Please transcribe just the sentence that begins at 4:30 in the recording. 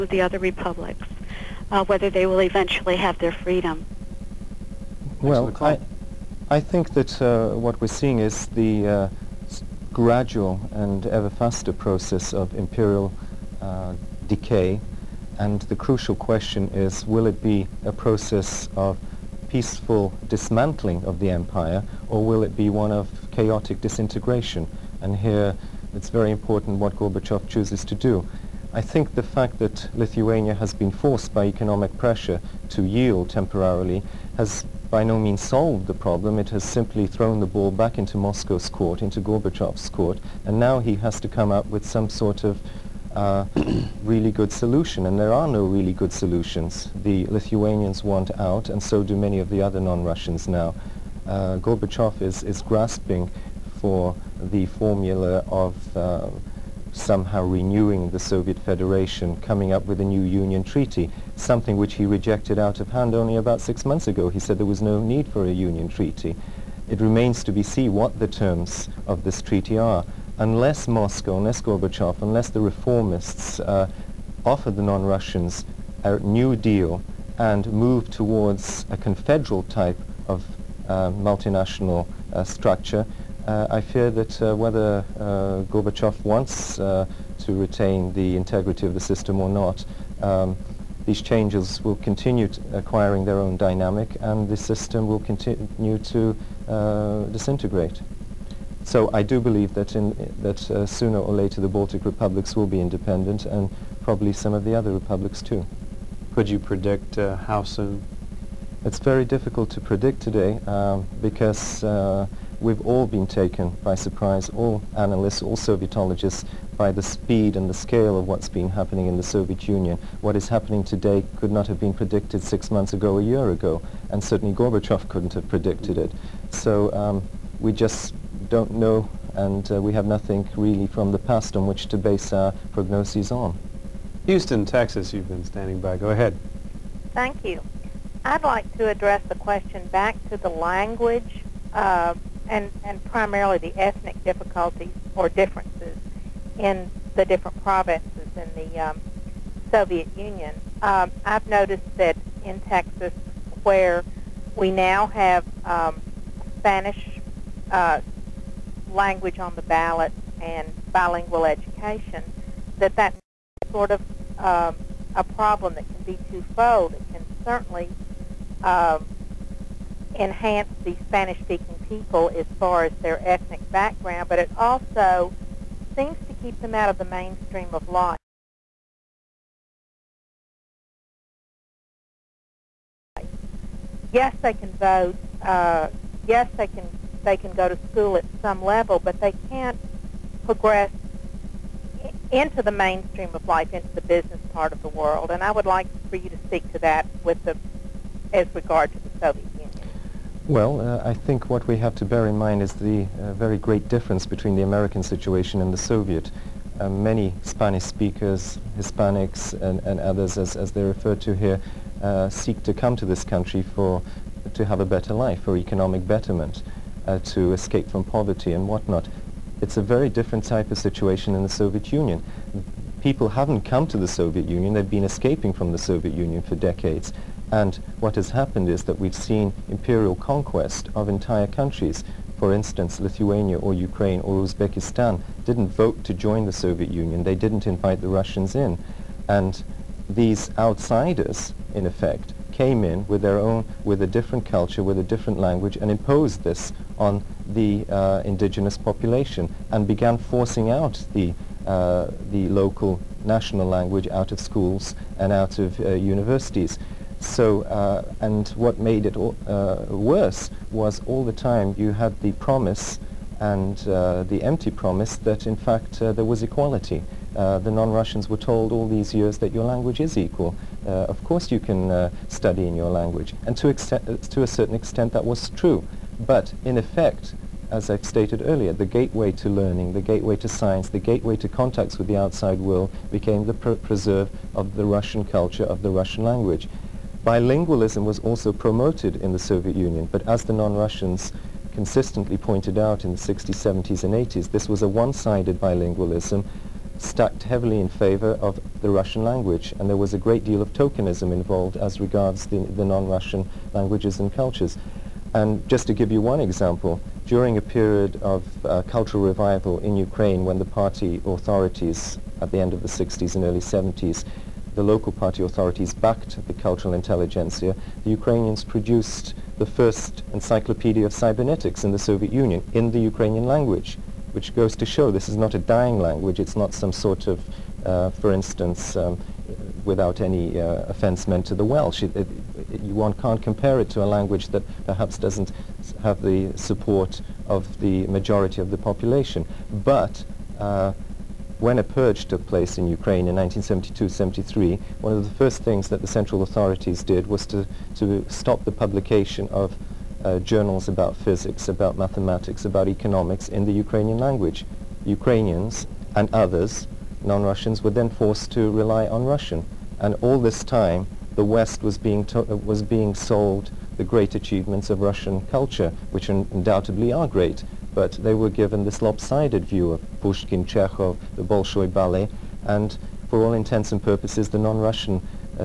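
Uh, of course you can study in your language.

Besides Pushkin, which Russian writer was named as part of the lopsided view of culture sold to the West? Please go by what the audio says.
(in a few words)
Chekhov.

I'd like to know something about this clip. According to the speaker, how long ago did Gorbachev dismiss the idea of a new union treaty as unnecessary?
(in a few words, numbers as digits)
about six months ago.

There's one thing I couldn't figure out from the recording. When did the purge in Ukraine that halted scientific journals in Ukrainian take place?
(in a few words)
1972-73.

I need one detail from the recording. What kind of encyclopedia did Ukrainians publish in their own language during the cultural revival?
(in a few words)
cybernetics.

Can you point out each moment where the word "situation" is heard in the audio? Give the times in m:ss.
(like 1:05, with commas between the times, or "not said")
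3:25, 3:40.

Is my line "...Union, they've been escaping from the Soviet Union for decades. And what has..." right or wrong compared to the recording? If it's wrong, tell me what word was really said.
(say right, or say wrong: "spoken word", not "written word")
right.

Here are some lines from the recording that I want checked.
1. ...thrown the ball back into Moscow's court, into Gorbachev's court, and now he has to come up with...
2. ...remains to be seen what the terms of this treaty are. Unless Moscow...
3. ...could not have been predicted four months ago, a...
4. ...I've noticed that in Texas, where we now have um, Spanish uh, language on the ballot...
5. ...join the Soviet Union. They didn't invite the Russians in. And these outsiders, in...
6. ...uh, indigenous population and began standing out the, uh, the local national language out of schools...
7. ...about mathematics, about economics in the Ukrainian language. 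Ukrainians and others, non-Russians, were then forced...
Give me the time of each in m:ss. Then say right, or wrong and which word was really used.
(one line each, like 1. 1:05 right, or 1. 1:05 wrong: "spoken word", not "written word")
1. 0:37 right
2. 1:06 right
3. 2:01 wrong: "six", not "four"
4. 2:31 right
5. 3:56 right
6. 4:07 wrong: "forcing", not "standing"
7. 5:51 right.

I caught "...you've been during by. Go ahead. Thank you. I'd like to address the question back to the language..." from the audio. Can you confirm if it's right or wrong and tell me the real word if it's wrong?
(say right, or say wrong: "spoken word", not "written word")
wrong: "standing", not "during".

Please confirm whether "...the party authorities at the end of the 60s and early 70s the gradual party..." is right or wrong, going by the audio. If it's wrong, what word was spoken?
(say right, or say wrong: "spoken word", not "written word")
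wrong: "local", not "gradual".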